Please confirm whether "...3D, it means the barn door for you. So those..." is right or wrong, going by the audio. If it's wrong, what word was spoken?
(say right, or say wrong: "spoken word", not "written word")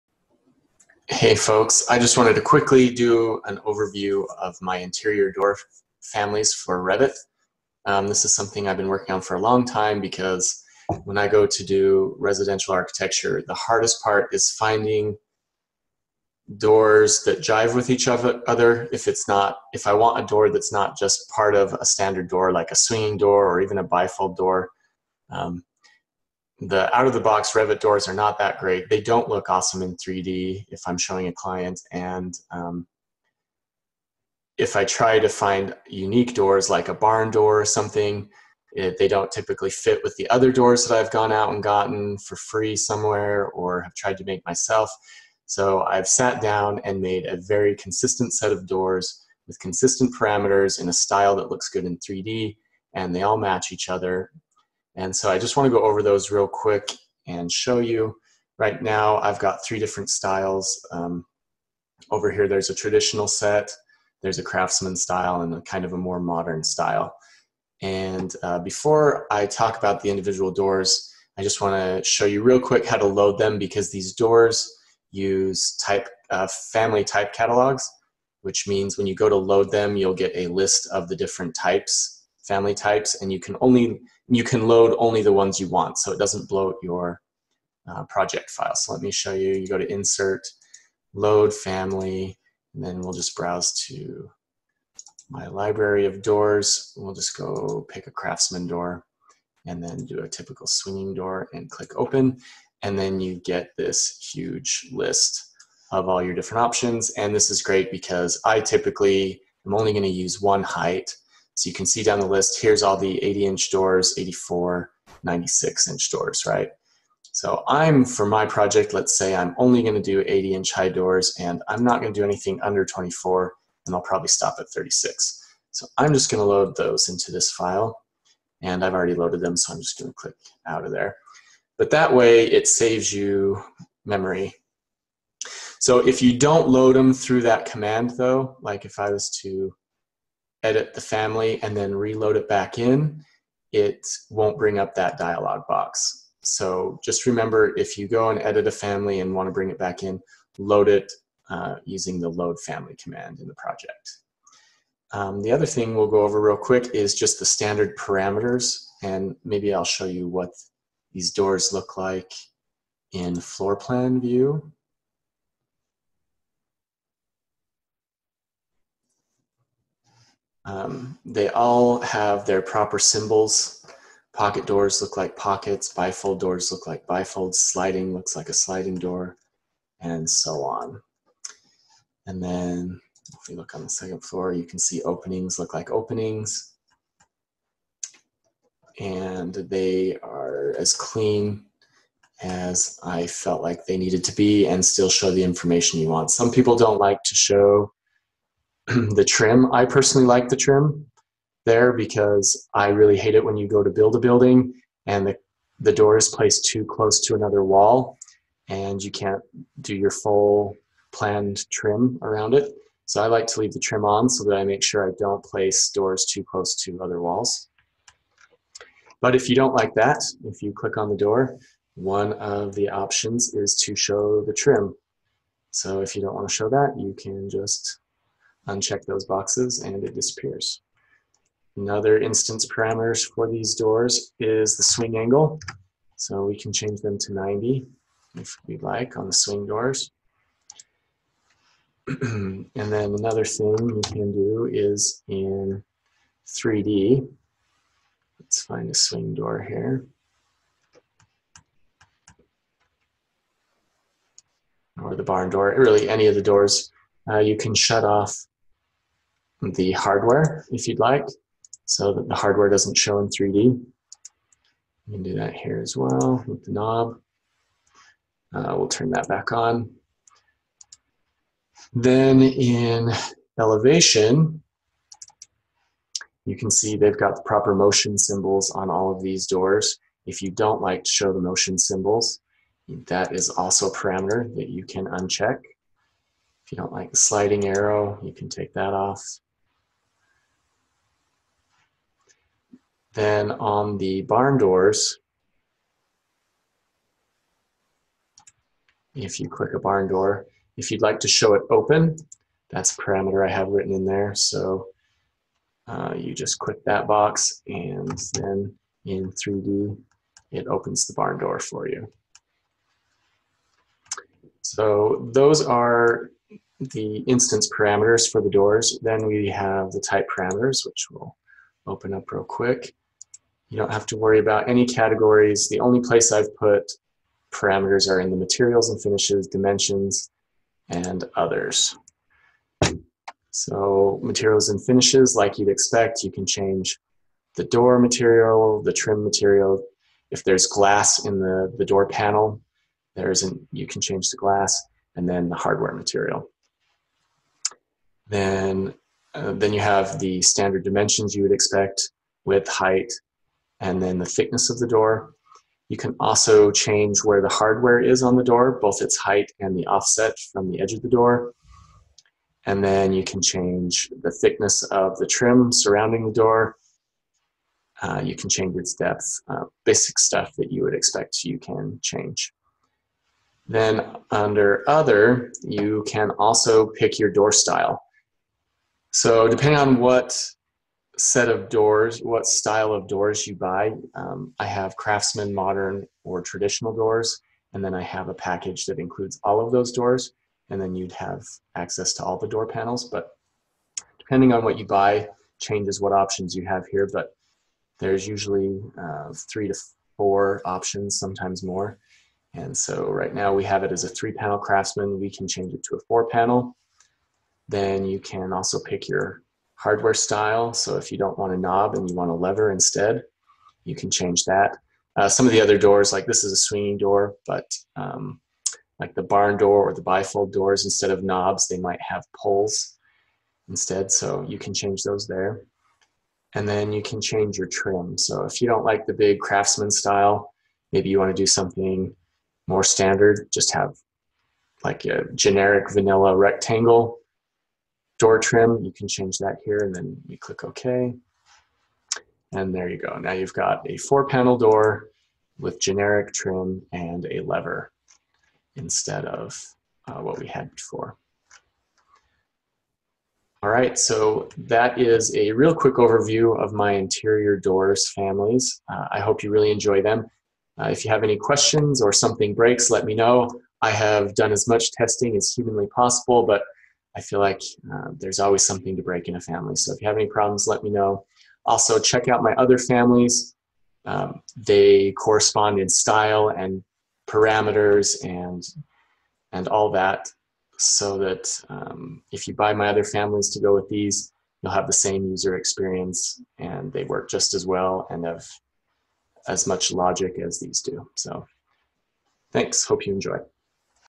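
wrong: "opens", not "means".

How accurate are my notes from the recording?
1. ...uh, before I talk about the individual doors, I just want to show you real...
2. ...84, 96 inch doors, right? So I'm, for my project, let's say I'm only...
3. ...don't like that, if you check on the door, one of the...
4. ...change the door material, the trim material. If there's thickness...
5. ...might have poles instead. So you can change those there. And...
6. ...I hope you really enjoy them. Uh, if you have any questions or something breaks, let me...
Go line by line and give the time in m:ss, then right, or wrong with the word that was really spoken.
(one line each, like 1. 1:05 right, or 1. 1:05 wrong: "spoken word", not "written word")
1. 1:08 right
2. 1:54 right
3. 3:39 wrong: "click", not "check"
4. 5:36 wrong: "glass", not "thickness"
5. 7:01 right
6. 7:39 right.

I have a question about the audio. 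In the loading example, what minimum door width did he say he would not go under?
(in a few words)
24.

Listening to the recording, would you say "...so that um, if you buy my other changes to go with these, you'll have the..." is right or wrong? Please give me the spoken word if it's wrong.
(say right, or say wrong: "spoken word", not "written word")
wrong: "families", not "changes".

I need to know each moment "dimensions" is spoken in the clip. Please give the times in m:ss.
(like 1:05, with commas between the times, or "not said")
5:29, 5:50.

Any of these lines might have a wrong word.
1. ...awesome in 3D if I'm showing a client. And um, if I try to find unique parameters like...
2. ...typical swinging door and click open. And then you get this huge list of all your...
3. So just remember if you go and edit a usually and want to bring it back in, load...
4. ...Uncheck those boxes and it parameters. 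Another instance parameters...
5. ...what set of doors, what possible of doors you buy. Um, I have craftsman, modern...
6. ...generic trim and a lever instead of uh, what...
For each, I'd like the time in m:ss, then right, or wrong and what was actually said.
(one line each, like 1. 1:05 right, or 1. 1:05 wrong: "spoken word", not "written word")
1. 0:29 wrong: "doors", not "parameters"
2. 1:40 right
3. 2:26 wrong: "family", not "usually"
4. 3:48 wrong: "disappears", not "parameters"
5. 6:19 wrong: "style", not "possible"
6. 7:25 right.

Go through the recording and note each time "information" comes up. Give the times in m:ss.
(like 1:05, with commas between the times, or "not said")
3:15.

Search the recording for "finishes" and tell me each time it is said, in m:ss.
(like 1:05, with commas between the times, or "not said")
5:29, 5:34.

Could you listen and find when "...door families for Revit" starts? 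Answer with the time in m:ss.
0:05.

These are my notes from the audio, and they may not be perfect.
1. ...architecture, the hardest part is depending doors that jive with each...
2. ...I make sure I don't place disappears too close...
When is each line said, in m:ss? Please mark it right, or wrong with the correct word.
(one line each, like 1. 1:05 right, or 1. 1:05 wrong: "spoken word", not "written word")
1. 0:12 wrong: "finding", not "depending"
2. 3:34 wrong: "doors", not "disappears".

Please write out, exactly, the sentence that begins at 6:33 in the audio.
But depending on what you buy, changes what options you have here.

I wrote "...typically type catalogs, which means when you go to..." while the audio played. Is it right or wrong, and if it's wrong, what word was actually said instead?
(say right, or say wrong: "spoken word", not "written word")
wrong: "family", not "typically".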